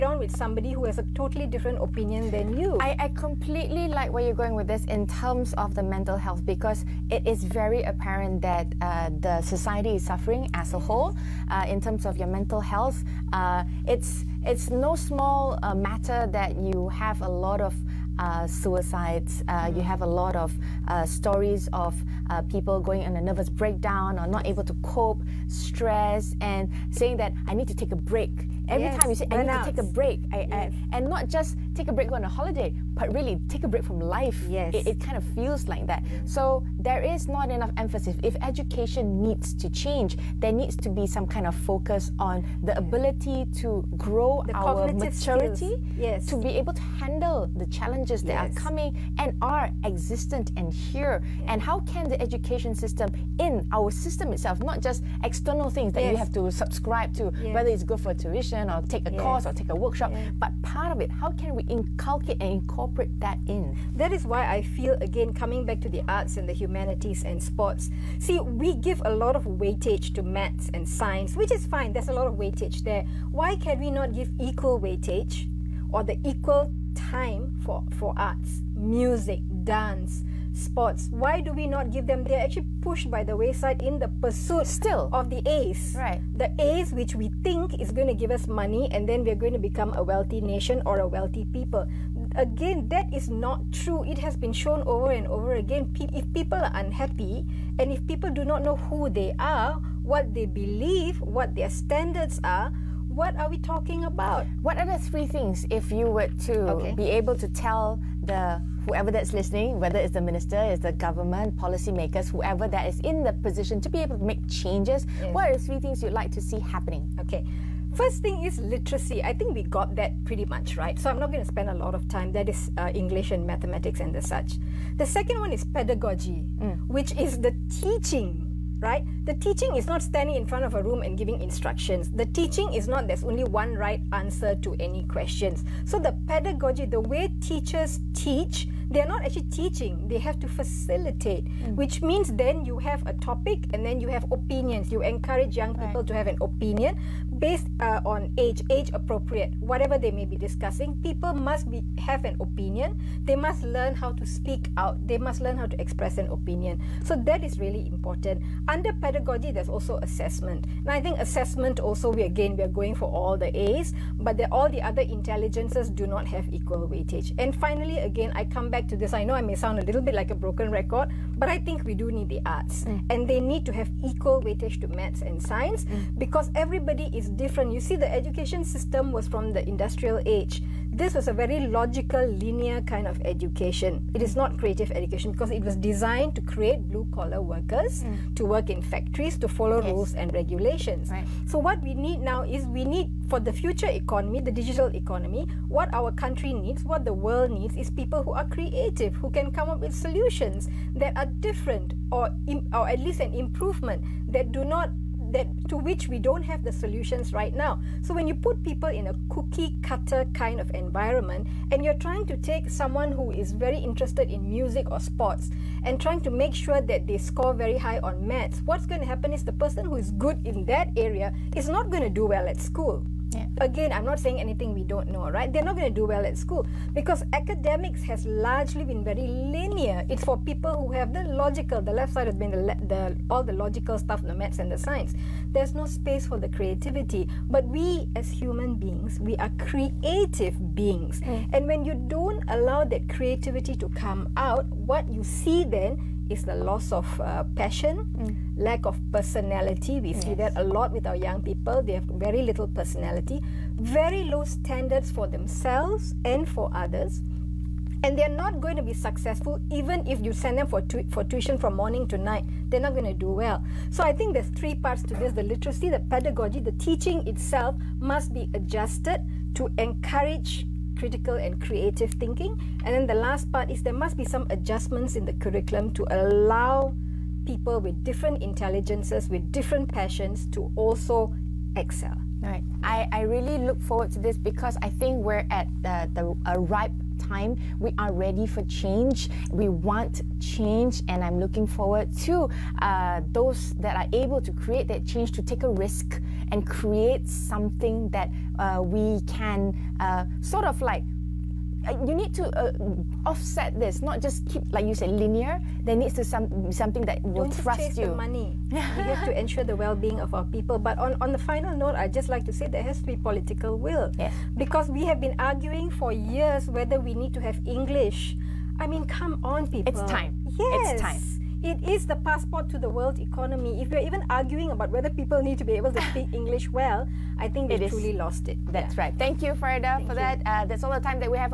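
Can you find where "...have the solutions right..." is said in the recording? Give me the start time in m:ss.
3:26.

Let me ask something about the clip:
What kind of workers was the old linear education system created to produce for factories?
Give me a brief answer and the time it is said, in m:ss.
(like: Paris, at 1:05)
Blue collar workers, at 3:06.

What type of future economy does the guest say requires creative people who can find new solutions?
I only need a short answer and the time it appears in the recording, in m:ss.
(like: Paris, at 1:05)
The digital economy, at 3:14.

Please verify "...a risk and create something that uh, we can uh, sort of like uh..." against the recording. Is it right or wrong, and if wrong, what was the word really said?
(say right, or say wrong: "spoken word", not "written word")
right.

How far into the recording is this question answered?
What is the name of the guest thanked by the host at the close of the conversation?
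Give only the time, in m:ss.
5:29.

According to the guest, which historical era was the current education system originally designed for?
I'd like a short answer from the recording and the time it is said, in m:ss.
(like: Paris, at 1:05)
The industrial age, at 2:59.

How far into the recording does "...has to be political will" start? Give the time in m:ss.
5:12.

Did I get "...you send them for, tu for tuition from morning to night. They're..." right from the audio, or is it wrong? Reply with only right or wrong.
right.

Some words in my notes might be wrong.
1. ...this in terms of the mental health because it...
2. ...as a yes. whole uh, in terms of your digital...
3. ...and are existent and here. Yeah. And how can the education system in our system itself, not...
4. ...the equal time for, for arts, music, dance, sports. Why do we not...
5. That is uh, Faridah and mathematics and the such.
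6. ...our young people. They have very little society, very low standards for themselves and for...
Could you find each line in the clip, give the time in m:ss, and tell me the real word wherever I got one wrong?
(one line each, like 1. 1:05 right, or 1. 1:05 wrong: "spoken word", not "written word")
1. 0:04 right
2. 0:10 wrong: "mental", not "digital"
3. 0:49 right
4. 1:16 right
5. 2:02 wrong: "English", not "Faridah"
6. 4:11 wrong: "personality", not "society".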